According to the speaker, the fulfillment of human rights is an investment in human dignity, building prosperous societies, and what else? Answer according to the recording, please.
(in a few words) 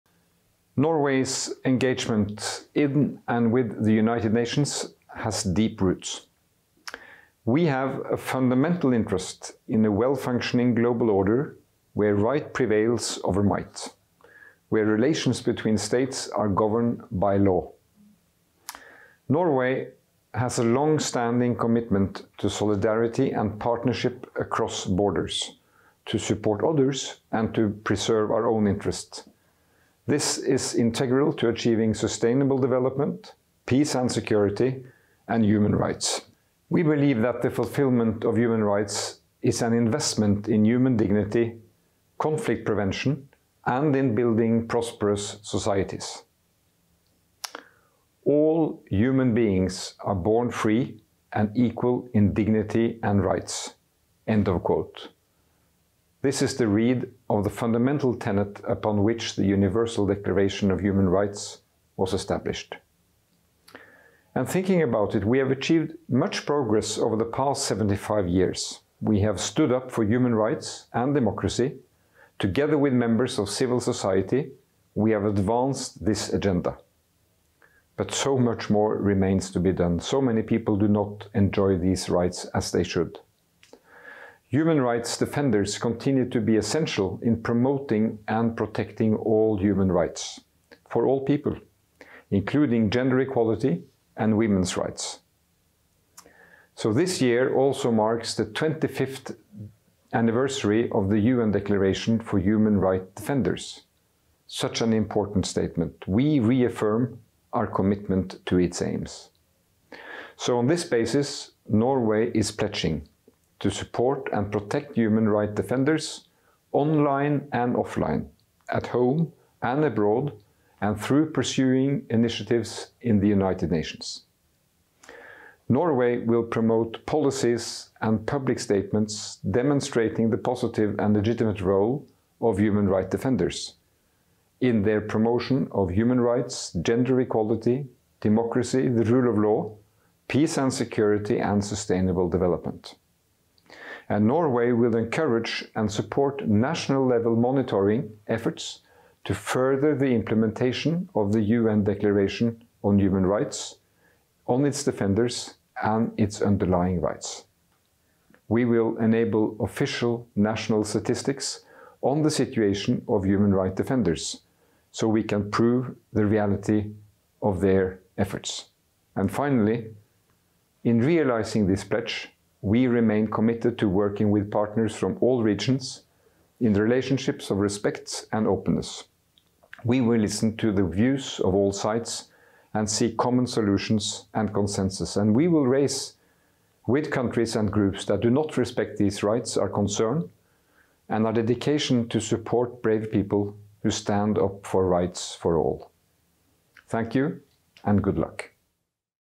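conflict prevention.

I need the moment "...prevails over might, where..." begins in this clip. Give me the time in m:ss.
0:12.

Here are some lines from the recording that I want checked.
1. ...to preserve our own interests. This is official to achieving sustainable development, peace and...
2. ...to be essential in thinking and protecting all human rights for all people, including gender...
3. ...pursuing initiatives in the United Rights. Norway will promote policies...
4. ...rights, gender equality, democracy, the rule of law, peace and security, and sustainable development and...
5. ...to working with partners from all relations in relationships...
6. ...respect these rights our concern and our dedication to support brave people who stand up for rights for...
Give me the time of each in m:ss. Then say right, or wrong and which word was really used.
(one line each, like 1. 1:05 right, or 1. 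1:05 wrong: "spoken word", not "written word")
1. 0:27 wrong: "integral", not "official"
2. 1:26 wrong: "promoting", not "thinking"
3. 2:01 wrong: "Nations", not "Rights"
4. 2:16 right
5. 2:53 wrong: "regions", not "relations"
6. 3:08 right.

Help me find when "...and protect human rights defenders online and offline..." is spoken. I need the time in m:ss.
1:54.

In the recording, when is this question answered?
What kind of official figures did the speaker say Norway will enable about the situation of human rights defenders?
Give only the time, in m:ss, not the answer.
2:40.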